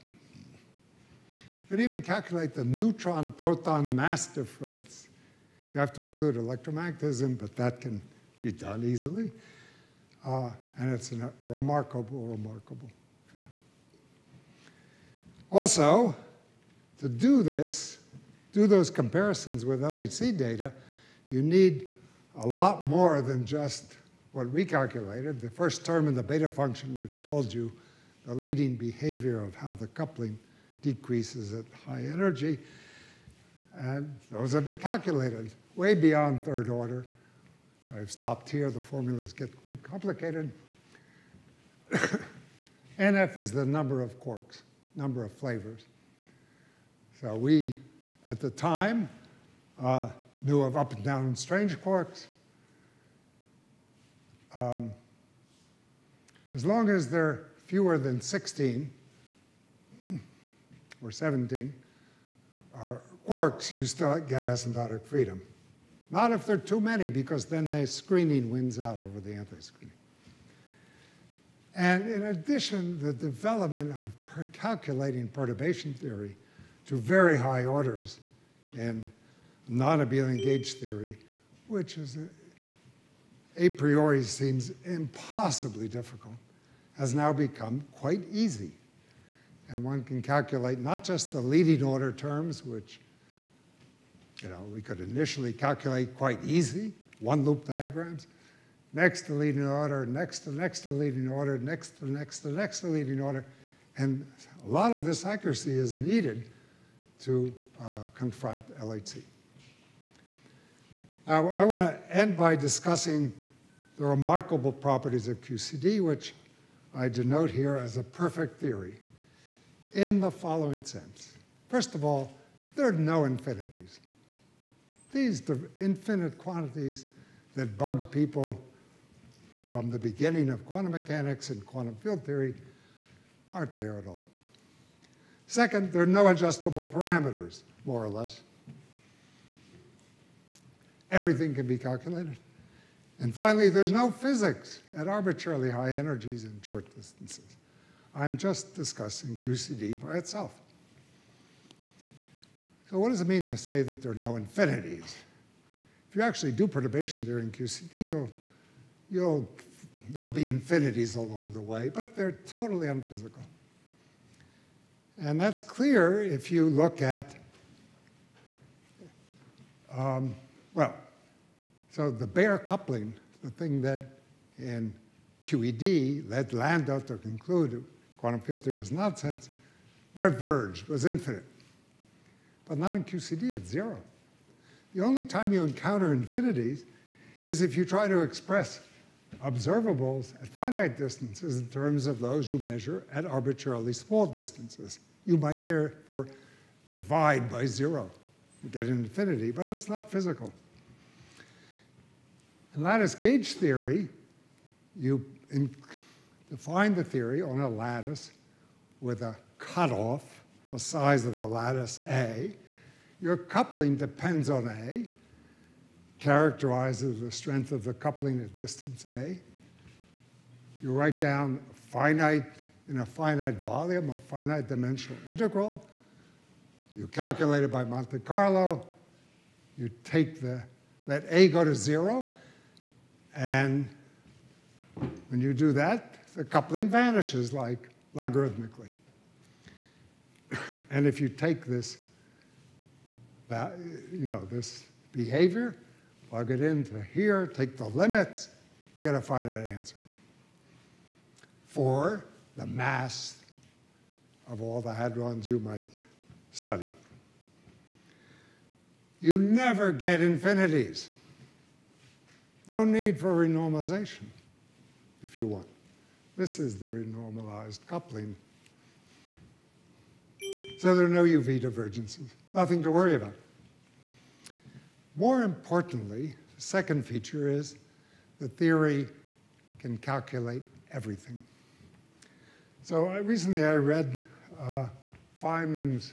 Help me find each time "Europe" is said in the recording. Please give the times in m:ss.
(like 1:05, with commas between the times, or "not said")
not said.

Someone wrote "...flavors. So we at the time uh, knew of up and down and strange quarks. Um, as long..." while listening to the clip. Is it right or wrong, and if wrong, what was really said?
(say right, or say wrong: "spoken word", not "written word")
right.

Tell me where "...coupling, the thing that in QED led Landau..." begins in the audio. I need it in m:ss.
2:52.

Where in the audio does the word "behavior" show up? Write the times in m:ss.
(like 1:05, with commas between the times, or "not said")
0:28, 4:05.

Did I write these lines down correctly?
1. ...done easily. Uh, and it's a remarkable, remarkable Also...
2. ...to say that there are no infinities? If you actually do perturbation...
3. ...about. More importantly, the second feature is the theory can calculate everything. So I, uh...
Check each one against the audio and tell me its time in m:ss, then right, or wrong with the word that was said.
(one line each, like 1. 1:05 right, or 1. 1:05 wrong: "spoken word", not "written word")
1. 0:08 right
2. 2:33 right
3. 4:33 right.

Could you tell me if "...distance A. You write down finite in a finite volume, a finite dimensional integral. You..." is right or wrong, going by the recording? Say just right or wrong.
right.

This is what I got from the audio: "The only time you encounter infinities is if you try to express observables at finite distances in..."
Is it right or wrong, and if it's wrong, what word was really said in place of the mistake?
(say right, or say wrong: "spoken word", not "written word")
right.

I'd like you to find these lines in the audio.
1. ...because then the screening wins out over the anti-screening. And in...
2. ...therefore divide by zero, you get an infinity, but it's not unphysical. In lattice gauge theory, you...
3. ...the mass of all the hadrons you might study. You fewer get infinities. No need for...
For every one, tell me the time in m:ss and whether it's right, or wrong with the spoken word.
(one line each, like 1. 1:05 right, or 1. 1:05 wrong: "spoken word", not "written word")
1. 1:07 right
2. 3:15 wrong: "physical", not "unphysical"
3. 4:12 wrong: "never", not "fewer".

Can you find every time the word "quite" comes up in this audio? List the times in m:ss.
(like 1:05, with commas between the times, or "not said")
0:39, 1:27, 1:36.